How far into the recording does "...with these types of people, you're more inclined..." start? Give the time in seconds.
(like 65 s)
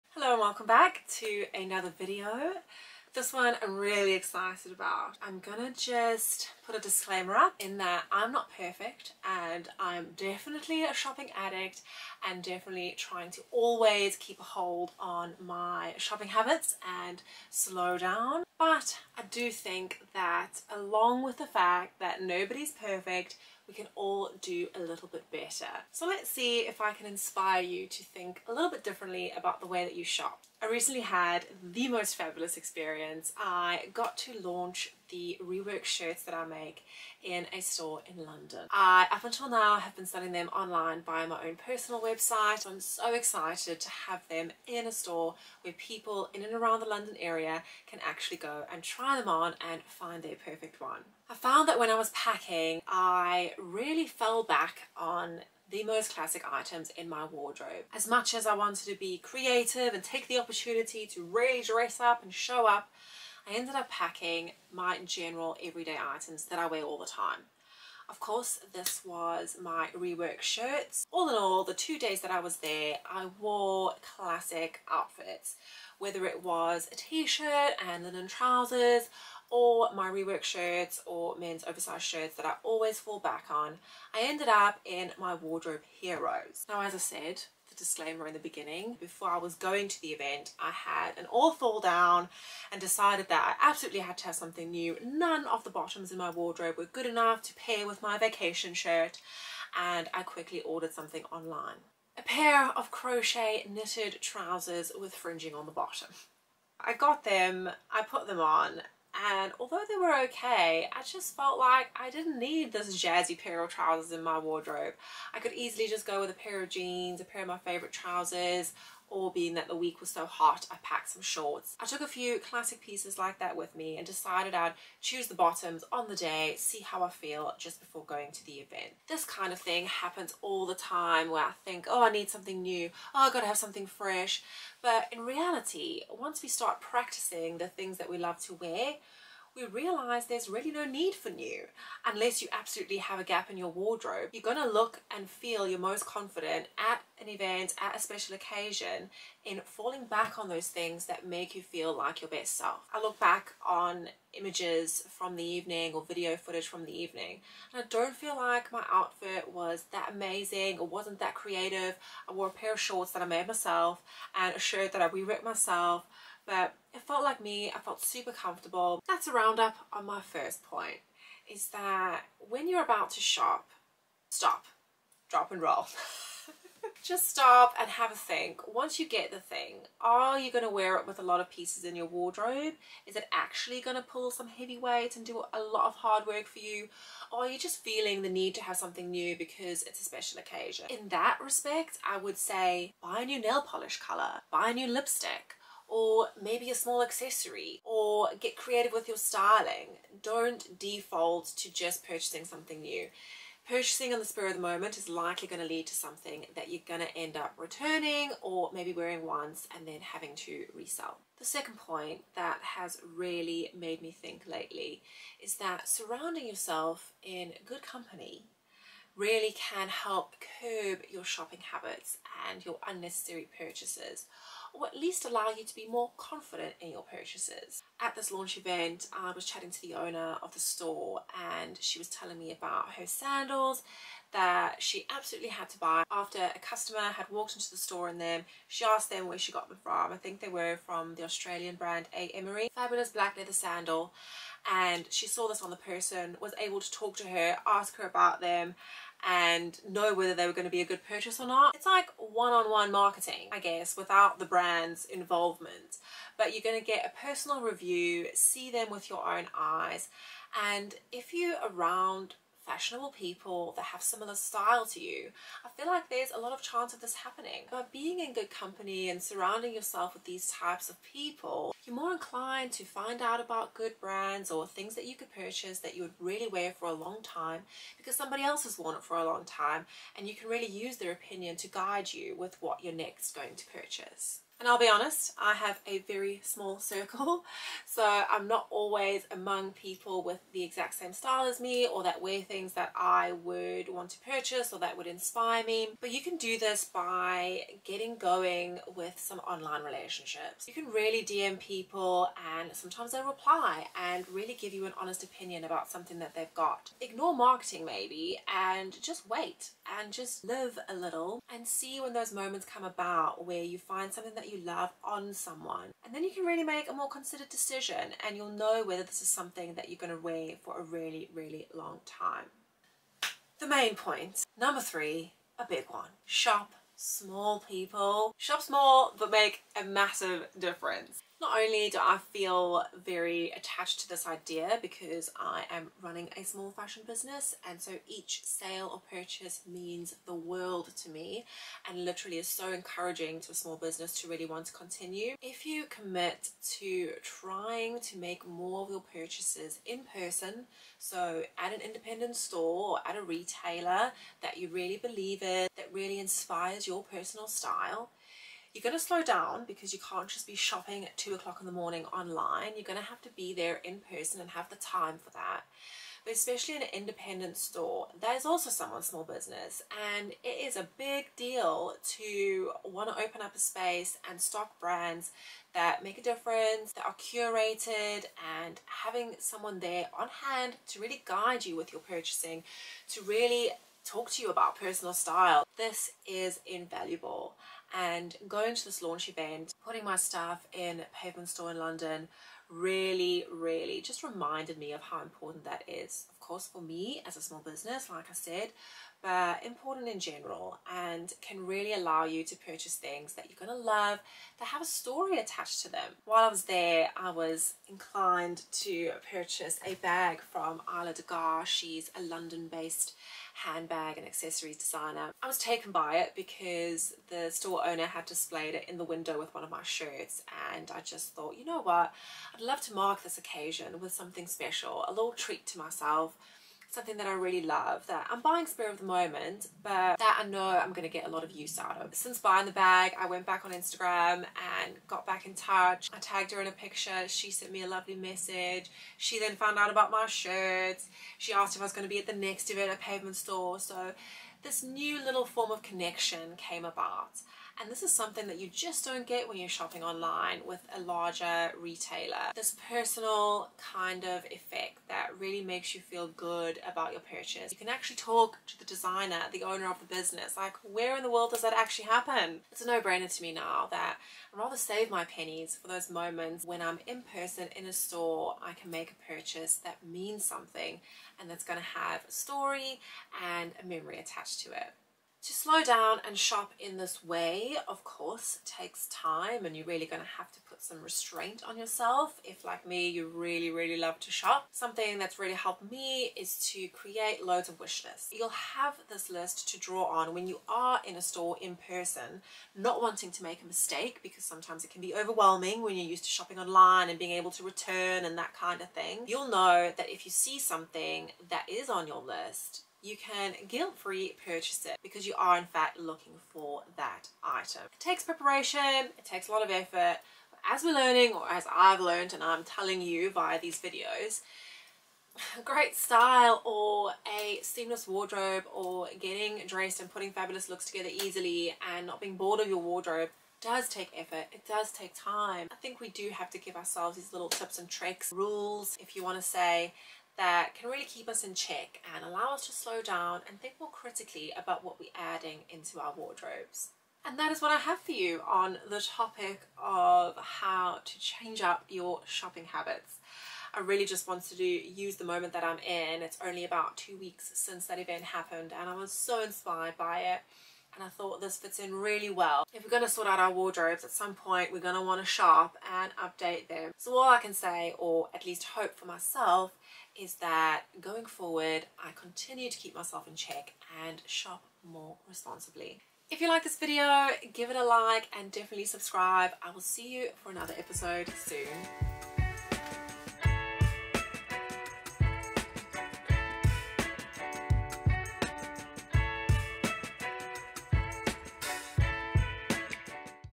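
270 s.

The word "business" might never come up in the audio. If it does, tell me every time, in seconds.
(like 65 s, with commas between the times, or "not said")
337 s, 343 s, 369 s, 397 s, 460 s.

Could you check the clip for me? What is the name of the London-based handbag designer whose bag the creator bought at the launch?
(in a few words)
Isla Gar.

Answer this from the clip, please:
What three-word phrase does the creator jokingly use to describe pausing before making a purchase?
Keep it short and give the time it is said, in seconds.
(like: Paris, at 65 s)
Stop, drop and roll, at 174 s.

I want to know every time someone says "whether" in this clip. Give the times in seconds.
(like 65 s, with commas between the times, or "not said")
75 s, 250 s, 318 s.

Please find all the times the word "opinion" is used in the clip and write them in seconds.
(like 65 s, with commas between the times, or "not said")
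281 s, 305 s.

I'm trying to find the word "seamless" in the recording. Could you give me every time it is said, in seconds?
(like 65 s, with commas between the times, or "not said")
517 s.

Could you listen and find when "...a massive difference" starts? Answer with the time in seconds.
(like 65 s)
329 s.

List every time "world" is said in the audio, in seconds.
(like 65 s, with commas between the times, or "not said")
340 s, 461 s.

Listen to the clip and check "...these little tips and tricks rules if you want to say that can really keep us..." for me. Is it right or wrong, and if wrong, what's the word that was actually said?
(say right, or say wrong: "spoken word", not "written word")
right.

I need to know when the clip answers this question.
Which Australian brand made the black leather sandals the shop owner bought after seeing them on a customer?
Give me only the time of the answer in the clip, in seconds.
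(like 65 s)
242 s.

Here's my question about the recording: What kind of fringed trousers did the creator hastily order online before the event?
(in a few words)
Crochet knitted trousers.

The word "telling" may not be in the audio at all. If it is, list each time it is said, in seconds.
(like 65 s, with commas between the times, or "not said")
232 s, 512 s.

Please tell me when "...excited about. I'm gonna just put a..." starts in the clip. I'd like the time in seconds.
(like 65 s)
4 s.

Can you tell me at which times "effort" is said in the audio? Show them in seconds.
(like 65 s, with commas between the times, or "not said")
509 s, 524 s.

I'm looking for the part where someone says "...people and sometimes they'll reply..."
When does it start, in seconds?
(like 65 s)
301 s.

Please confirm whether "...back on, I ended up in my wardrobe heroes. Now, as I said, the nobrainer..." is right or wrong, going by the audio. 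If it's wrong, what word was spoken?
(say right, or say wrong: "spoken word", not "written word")
wrong: "disclaimer", not "nobrainer".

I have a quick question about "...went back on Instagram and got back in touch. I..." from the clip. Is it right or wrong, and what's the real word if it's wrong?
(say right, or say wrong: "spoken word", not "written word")
right.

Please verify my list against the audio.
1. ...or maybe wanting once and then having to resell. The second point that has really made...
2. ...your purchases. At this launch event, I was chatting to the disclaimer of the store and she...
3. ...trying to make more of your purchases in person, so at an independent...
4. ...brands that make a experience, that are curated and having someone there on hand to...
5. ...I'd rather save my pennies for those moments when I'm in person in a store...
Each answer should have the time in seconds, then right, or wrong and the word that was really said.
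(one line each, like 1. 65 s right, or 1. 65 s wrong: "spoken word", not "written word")
1. 208 s wrong: "wearing", not "wanting"
2. 226 s wrong: "owner", not "disclaimer"
3. 347 s right
4. 374 s wrong: "difference", not "experience"
5. 464 s right.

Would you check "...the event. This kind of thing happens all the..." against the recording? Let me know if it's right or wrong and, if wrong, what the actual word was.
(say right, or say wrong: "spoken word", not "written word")
right.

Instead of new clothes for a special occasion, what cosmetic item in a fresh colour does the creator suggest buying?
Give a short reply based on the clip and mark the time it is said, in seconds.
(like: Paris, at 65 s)
Nail polish, at 193 s.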